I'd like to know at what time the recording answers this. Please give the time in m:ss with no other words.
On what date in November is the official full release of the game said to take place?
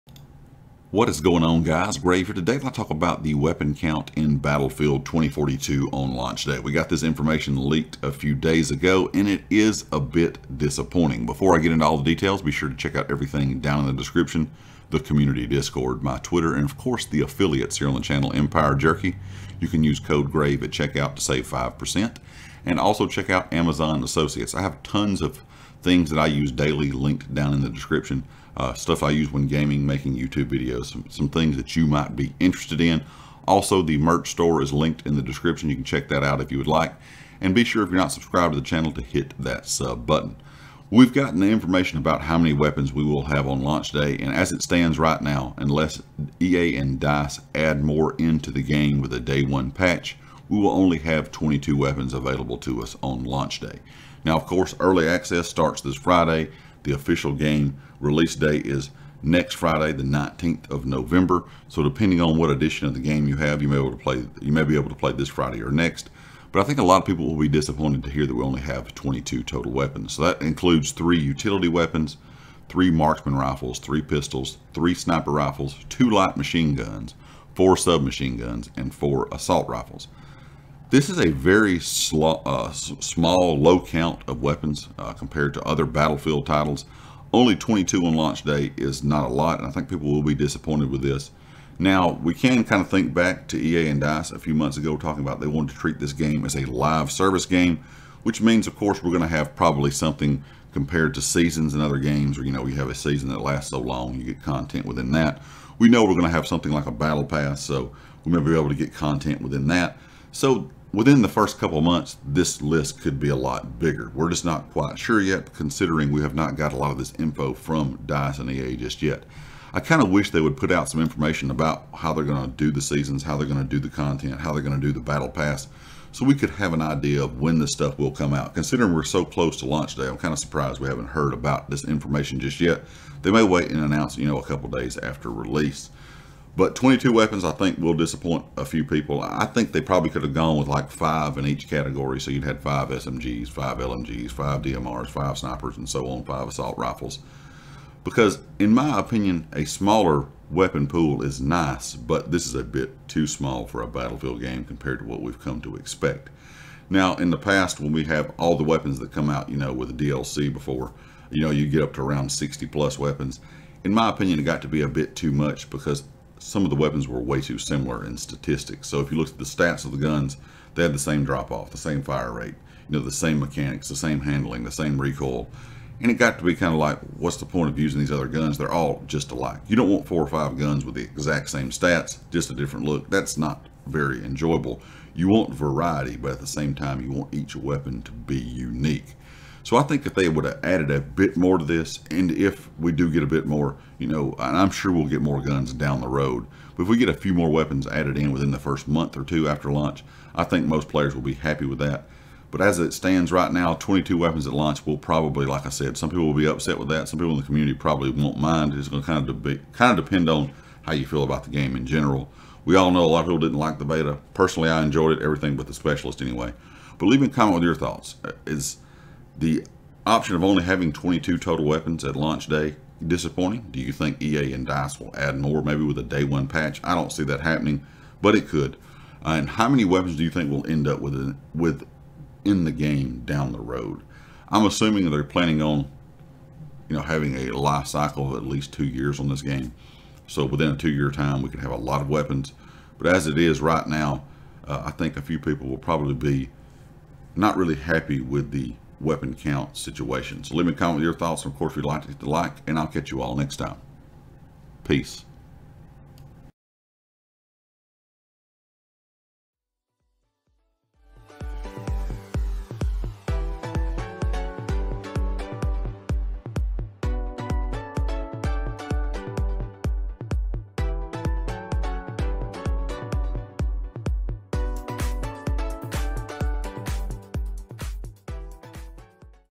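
0:59.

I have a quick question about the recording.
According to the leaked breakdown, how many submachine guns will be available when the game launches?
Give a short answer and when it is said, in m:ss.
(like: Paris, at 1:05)
4, at 1:17.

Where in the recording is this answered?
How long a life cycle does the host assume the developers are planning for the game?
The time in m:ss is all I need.
3:58.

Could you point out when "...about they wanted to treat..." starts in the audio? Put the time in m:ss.
1:35.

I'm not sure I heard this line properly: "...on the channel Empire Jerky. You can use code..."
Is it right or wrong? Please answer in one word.
right.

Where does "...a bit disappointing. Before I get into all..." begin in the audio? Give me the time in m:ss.
0:09.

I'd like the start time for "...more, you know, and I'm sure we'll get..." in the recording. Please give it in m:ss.
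3:13.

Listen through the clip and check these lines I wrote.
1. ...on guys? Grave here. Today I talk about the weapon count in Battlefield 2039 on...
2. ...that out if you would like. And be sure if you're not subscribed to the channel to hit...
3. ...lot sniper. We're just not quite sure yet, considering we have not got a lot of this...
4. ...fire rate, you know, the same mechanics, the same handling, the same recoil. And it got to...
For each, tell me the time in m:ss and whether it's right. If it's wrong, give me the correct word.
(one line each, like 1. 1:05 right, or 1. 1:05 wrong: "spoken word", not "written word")
1. 0:01 wrong: "2042", not "2039"
2. 0:36 right
3. 1:53 wrong: "bigger", not "sniper"
4. 2:52 right.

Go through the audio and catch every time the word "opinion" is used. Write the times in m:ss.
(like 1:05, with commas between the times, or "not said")
2:28, 2:44.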